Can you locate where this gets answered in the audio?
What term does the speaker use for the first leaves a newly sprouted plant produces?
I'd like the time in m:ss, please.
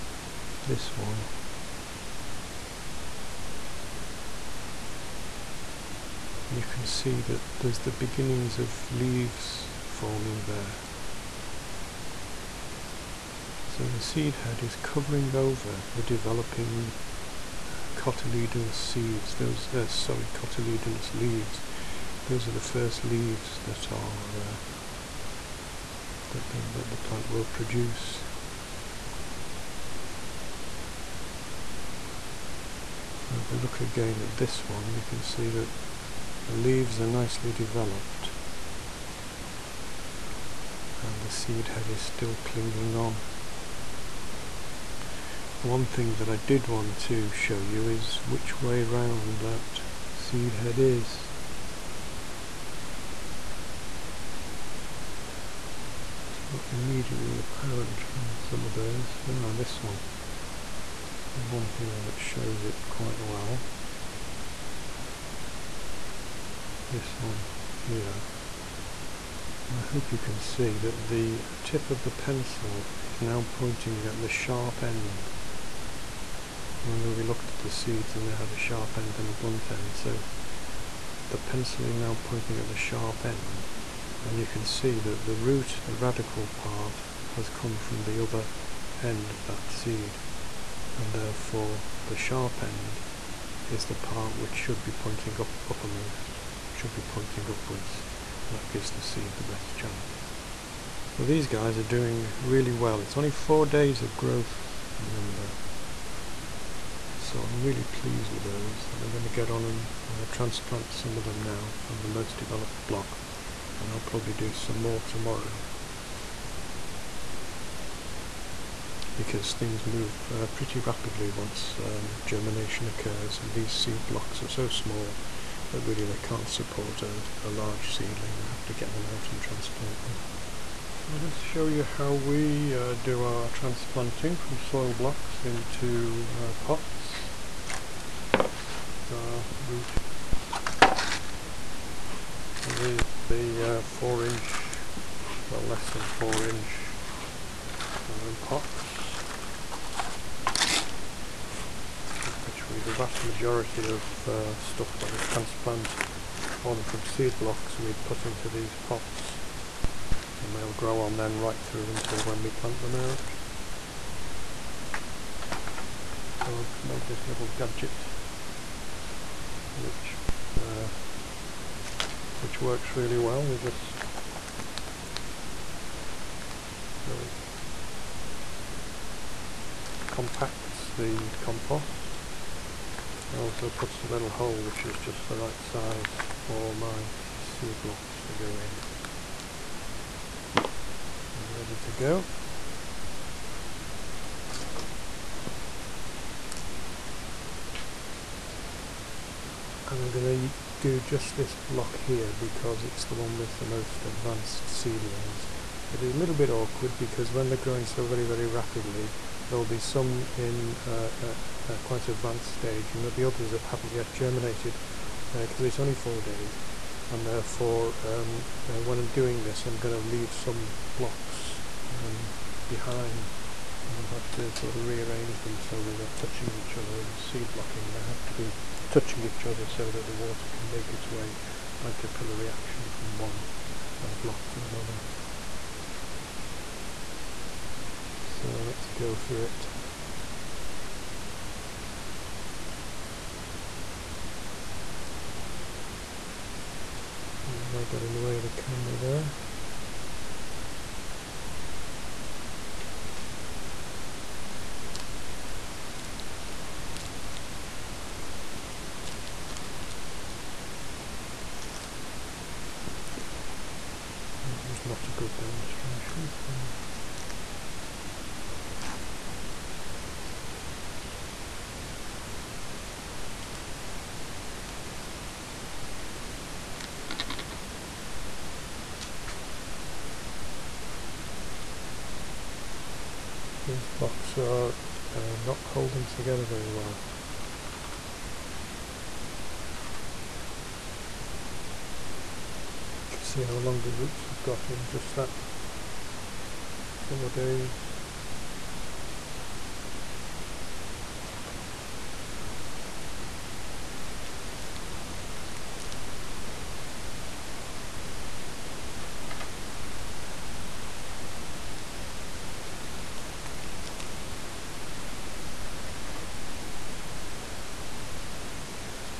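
0:20.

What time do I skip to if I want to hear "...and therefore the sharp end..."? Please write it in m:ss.
1:30.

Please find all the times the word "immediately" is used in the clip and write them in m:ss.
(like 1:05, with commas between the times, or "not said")
0:56.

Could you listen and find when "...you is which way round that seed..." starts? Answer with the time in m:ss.
0:47.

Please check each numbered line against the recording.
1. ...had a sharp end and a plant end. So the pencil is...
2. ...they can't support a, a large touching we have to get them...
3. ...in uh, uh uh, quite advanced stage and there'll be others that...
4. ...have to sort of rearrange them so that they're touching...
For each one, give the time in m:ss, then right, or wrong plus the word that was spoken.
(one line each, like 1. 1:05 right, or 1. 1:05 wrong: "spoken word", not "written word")
1. 1:18 wrong: "blunt", not "plant"
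2. 2:06 wrong: "seedling", not "touching"
3. 3:30 right
4. 3:44 right.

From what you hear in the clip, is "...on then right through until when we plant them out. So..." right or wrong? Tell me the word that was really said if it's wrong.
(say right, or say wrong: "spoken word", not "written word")
right.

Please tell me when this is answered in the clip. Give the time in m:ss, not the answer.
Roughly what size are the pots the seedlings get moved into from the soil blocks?
2:25.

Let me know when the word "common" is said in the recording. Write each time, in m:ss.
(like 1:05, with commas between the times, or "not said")
not said.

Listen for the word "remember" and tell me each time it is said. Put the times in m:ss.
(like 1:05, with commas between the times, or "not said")
1:16, 1:44.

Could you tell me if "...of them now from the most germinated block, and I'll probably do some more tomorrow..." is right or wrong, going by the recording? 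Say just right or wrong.
wrong.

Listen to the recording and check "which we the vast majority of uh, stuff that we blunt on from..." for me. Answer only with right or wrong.
wrong.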